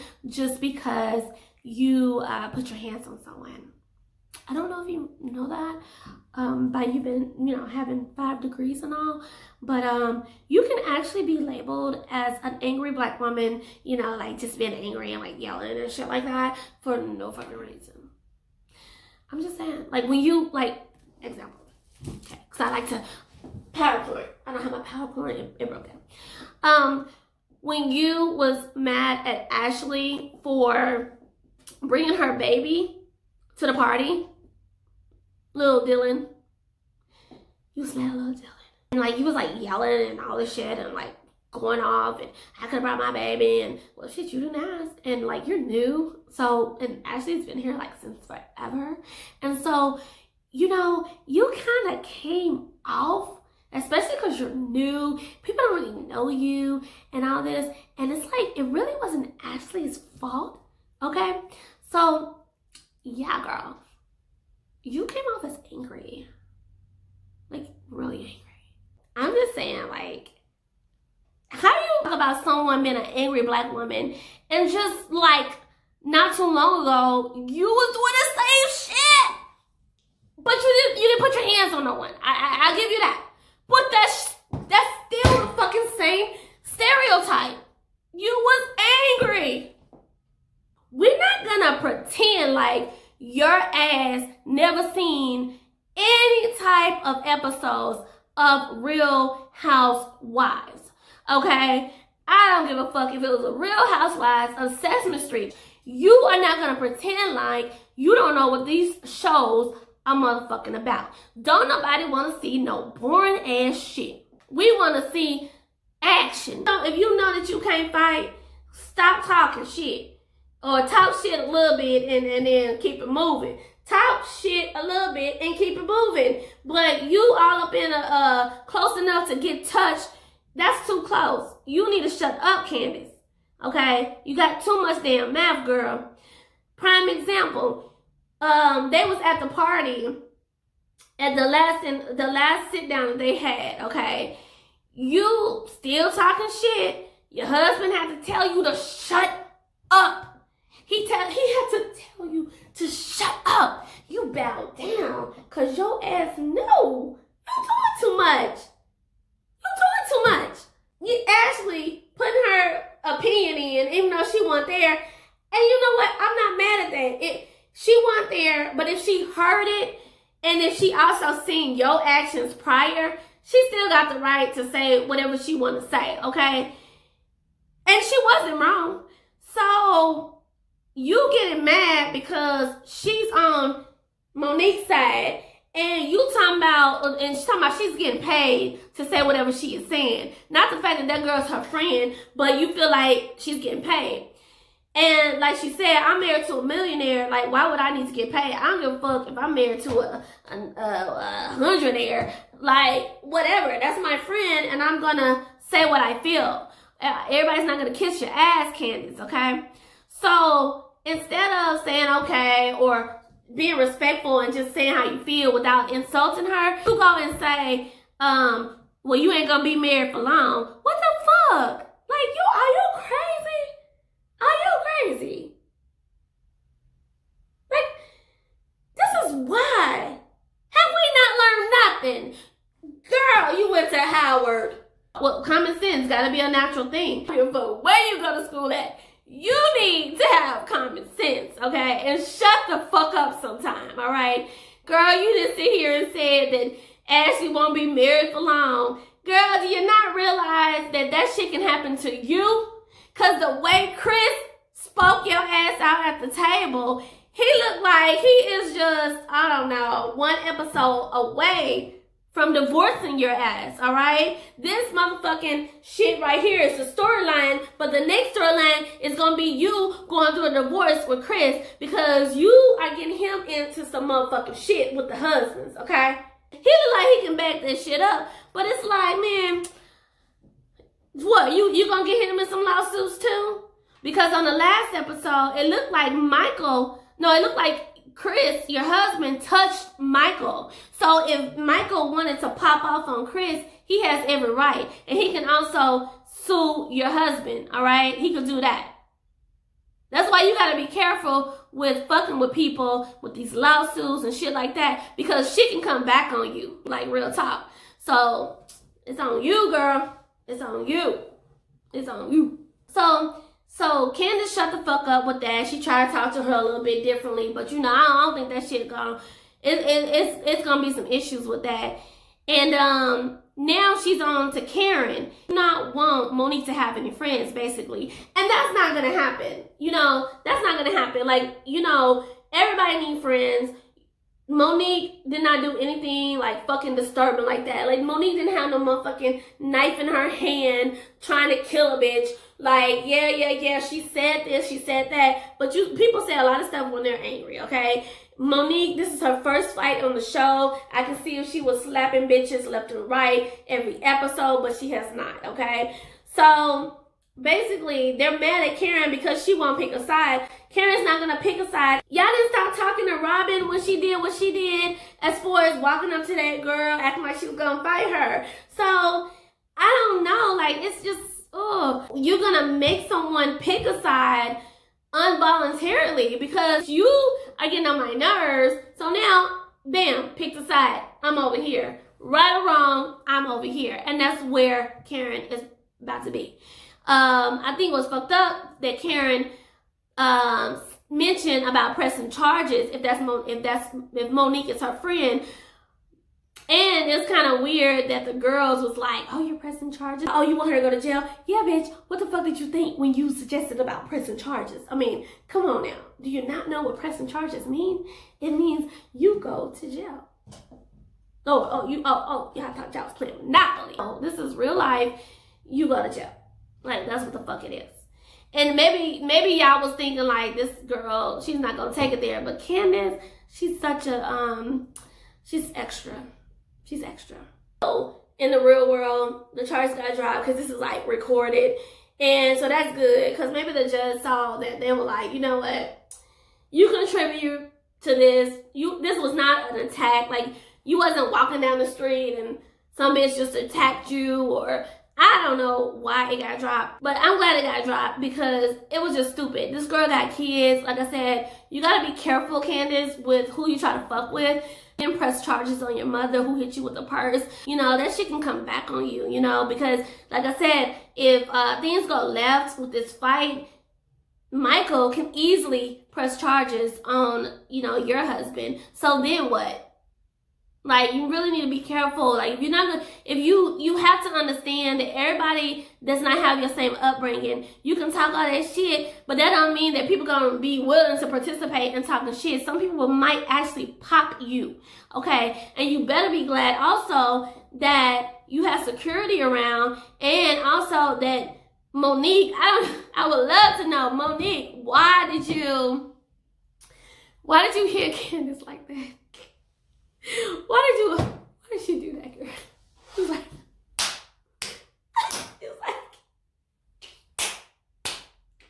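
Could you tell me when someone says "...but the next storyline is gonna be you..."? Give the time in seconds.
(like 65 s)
267 s.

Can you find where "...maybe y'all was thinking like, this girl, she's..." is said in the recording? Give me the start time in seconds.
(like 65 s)
419 s.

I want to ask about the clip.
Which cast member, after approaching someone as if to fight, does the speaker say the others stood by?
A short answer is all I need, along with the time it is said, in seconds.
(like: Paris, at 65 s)
Robyn, at 363 s.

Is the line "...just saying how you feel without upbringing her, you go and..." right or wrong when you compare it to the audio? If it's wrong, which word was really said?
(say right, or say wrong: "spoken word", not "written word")
wrong: "insulting", not "upbringing".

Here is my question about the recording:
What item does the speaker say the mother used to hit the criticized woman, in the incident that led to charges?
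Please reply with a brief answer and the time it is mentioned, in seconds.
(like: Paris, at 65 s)
A purse, at 457 s.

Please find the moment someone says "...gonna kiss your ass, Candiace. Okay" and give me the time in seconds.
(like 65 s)
207 s.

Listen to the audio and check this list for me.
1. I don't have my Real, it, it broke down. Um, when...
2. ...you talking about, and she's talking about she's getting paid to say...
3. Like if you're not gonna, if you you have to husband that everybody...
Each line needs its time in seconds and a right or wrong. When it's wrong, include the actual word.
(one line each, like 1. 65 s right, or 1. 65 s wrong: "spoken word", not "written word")
1. 24 s wrong: "PowerPoint", not "Real"
2. 186 s right
3. 472 s wrong: "understand", not "husband".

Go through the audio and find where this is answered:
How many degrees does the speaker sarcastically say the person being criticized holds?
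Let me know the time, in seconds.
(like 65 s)
8 s.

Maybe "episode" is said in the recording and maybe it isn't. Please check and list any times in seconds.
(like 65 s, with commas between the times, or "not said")
97 s, 260 s, 284 s, 354 s.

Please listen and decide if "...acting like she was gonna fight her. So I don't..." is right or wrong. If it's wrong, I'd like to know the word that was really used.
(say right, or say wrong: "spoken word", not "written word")
right.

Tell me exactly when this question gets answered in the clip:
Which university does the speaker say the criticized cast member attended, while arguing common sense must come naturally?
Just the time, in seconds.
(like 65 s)
233 s.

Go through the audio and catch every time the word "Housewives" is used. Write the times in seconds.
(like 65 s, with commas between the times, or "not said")
99 s, 103 s.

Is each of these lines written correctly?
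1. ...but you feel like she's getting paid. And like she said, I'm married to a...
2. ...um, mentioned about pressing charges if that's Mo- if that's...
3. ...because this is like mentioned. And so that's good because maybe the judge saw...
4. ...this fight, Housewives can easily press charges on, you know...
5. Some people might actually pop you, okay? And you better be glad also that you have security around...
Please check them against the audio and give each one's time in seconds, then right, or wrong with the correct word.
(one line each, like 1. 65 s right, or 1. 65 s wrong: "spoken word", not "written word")
1. 192 s right
2. 390 s right
3. 430 s wrong: "recorded", not "mentioned"
4. 462 s wrong: "Michael", not "Housewives"
5. 482 s right.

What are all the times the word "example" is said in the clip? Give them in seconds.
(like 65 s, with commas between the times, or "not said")
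21 s, 137 s.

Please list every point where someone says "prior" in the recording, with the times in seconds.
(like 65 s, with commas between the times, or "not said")
172 s.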